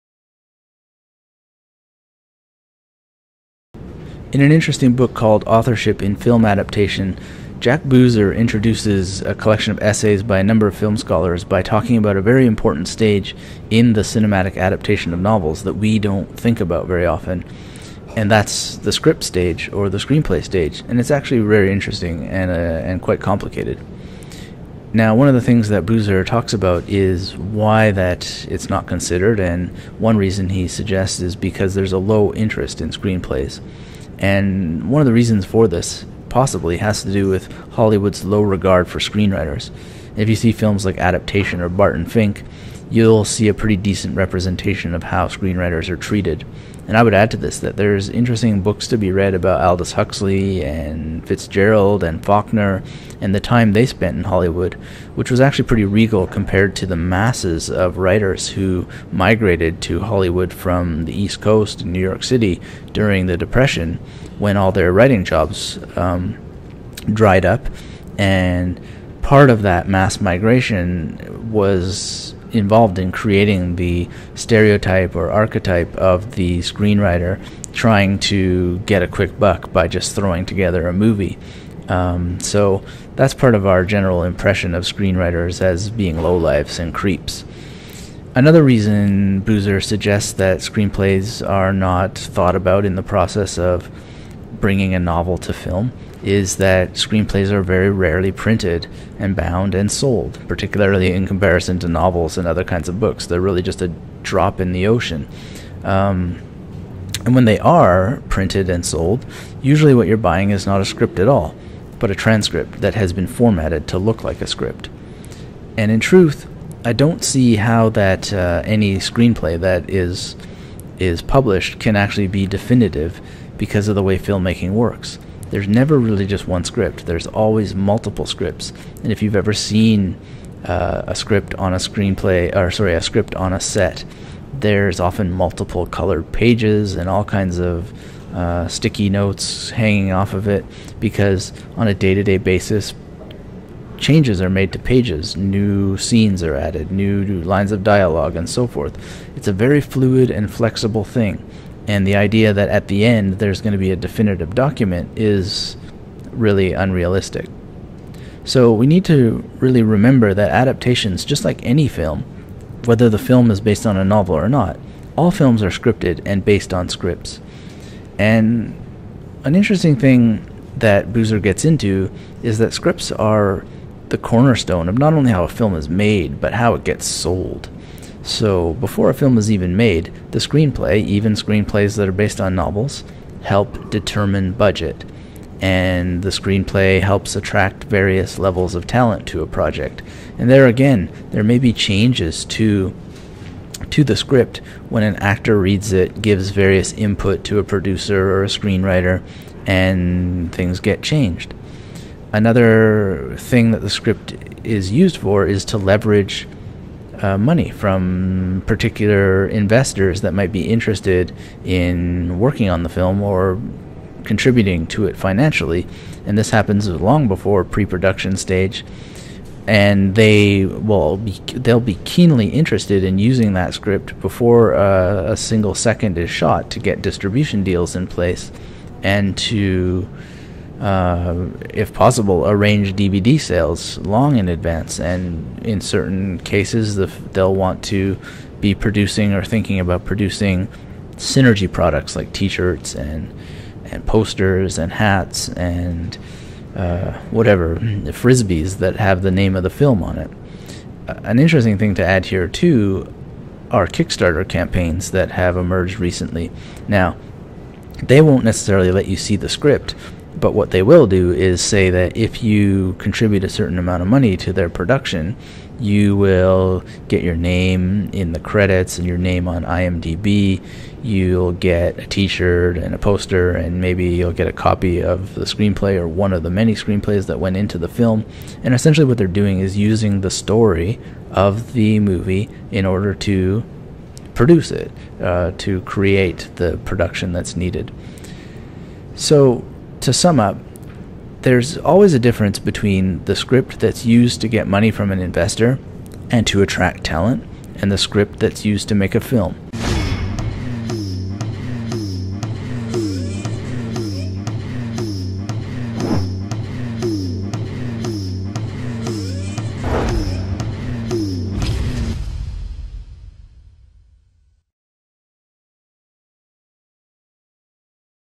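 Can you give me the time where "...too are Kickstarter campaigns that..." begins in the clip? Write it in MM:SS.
04:12.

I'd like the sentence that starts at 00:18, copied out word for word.
And that's the script stage or the screenplay stage.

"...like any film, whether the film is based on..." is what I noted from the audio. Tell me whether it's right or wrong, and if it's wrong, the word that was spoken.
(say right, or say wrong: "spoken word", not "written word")
right.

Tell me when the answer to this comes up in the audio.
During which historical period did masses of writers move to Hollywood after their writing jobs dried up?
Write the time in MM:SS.
01:03.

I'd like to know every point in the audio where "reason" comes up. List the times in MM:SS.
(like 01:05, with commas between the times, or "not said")
00:30, 00:35, 01:28.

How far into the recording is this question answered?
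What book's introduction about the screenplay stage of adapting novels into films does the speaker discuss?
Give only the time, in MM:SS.
00:05.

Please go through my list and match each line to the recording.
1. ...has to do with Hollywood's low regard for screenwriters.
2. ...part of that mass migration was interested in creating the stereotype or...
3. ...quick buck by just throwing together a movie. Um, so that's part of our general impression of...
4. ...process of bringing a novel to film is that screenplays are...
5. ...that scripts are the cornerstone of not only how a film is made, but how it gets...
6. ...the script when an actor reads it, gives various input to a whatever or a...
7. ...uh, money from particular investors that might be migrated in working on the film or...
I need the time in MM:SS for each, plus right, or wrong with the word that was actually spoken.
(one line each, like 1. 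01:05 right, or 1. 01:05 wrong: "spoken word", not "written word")
1. 00:36 right
2. 01:09 wrong: "involved", not "interested"
3. 01:19 right
4. 01:33 right
5. 02:52 right
6. 03:14 wrong: "producer", not "whatever"
7. 03:27 wrong: "interested", not "migrated".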